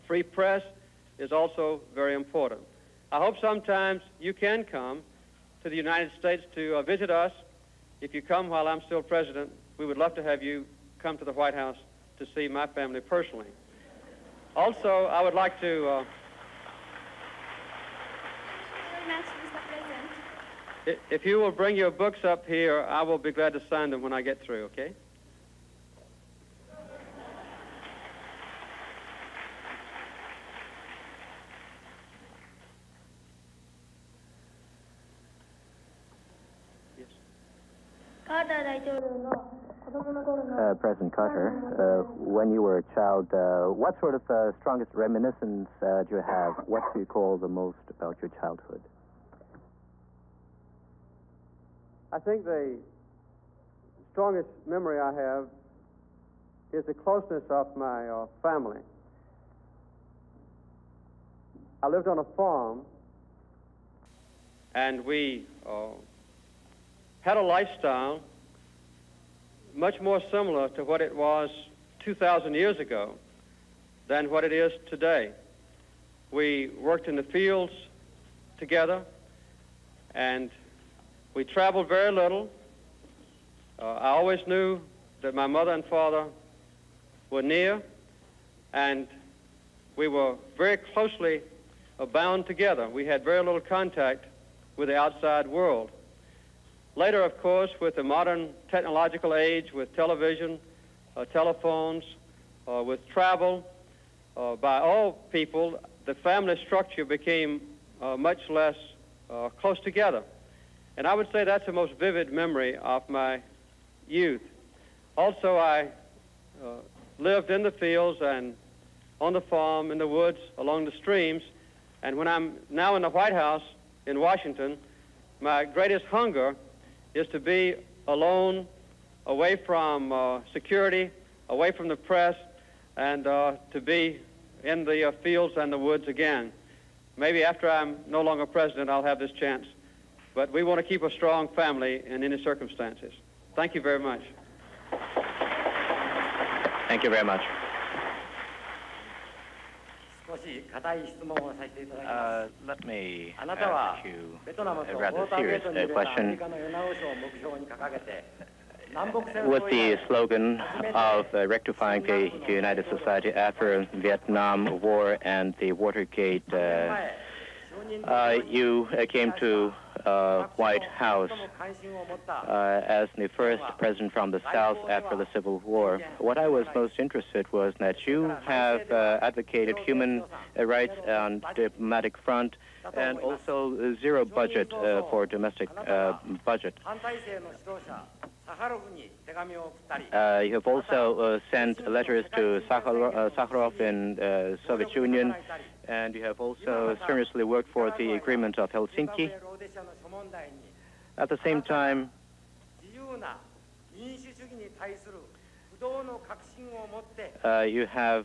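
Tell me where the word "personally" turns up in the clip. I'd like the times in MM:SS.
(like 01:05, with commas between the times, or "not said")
00:13.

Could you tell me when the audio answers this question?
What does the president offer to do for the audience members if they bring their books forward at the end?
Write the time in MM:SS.
00:23.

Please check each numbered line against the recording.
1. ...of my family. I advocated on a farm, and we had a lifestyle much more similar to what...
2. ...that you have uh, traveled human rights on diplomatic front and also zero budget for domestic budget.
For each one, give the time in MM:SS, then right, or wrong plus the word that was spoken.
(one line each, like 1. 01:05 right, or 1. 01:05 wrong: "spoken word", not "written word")
1. 00:57 wrong: "lived", not "advocated"
2. 02:57 wrong: "advocated", not "traveled".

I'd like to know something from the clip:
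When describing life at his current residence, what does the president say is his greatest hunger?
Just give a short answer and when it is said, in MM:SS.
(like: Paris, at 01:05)
To be alone, at 02:07.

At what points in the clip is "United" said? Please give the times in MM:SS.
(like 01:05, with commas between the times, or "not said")
00:05, 02:42.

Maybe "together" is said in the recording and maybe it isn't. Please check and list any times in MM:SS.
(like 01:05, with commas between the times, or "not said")
01:18, 01:32, 01:49.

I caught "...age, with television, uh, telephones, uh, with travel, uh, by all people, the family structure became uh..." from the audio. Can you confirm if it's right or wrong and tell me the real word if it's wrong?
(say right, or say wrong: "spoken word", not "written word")
right.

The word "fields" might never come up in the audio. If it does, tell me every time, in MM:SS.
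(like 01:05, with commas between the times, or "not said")
01:17, 01:57, 02:15.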